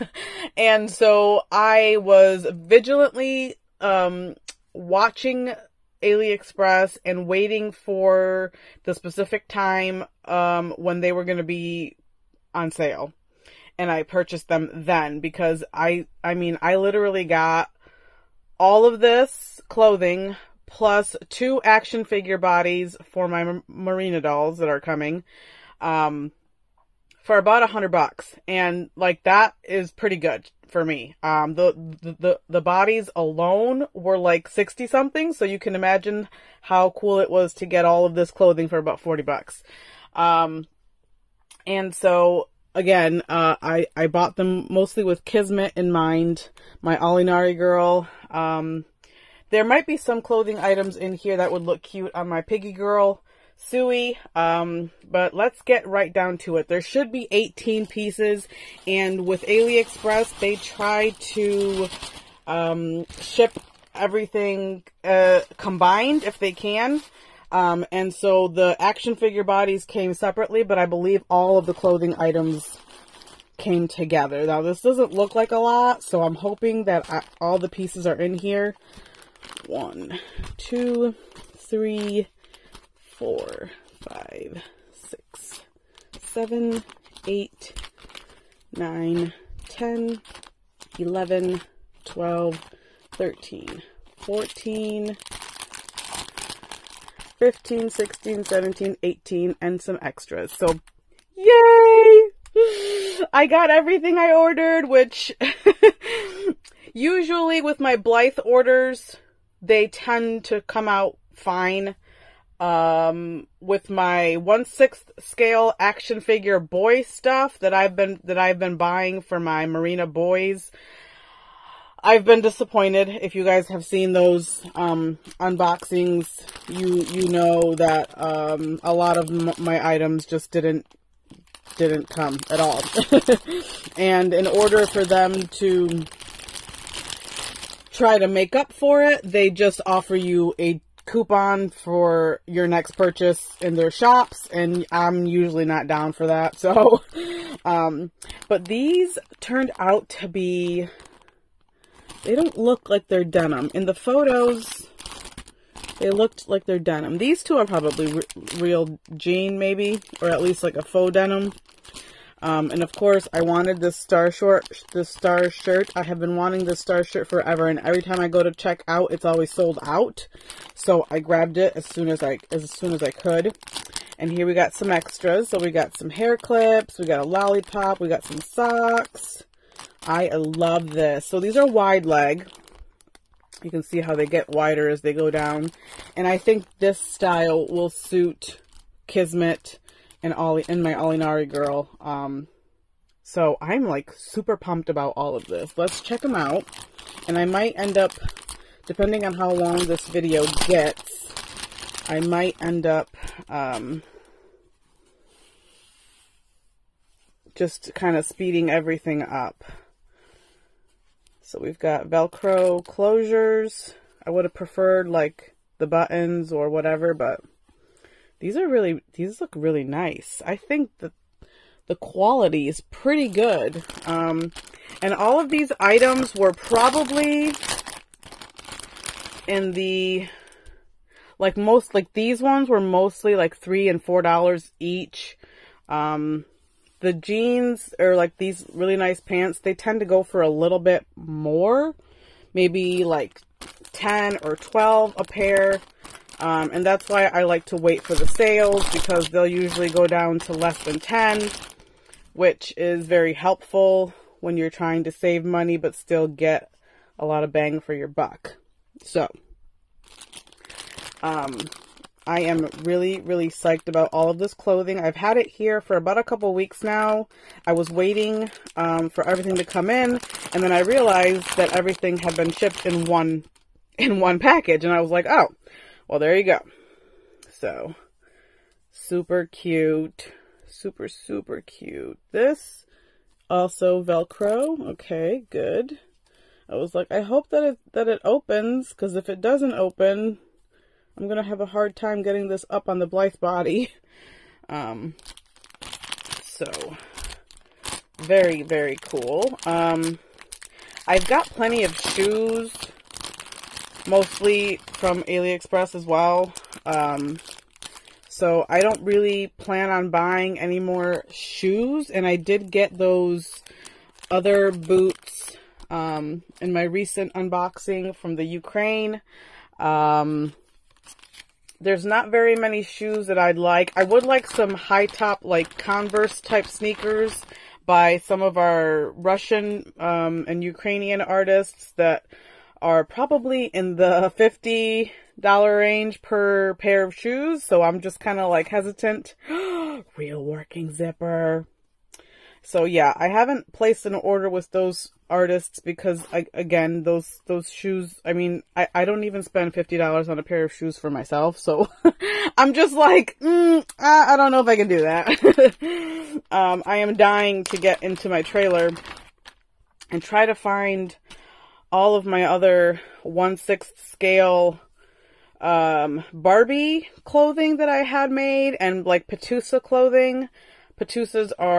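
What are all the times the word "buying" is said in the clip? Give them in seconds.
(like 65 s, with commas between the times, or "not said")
118 s, 310 s.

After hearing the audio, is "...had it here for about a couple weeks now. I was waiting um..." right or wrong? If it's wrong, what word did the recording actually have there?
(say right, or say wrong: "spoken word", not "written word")
right.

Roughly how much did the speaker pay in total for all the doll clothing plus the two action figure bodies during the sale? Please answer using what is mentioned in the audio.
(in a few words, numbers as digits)
About $100.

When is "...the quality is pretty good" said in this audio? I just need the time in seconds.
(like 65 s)
221 s.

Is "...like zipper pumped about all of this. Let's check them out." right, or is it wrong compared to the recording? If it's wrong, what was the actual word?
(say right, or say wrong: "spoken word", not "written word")
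wrong: "super", not "zipper".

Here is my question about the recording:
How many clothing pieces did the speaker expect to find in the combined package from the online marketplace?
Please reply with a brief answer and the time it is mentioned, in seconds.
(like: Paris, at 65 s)
18, at 57 s.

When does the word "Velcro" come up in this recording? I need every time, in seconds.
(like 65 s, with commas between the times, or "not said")
212 s, 284 s.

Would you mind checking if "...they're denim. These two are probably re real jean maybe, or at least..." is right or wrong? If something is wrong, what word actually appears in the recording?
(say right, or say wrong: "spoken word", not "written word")
right.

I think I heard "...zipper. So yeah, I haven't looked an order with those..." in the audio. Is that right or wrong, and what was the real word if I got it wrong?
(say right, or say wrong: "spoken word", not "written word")
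wrong: "placed", not "looked".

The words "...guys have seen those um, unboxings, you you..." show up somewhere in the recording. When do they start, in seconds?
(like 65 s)
123 s.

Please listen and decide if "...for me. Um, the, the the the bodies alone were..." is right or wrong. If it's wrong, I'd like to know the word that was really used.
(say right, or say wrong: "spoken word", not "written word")
right.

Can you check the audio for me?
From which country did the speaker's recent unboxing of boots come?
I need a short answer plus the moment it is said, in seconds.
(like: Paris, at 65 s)
Ukraine, at 318 s.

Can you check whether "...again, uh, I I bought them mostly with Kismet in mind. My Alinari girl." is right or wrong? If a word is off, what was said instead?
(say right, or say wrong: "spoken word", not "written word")
right.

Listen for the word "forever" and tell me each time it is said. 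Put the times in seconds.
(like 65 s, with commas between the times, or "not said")
167 s.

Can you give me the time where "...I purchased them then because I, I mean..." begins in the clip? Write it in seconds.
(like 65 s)
13 s.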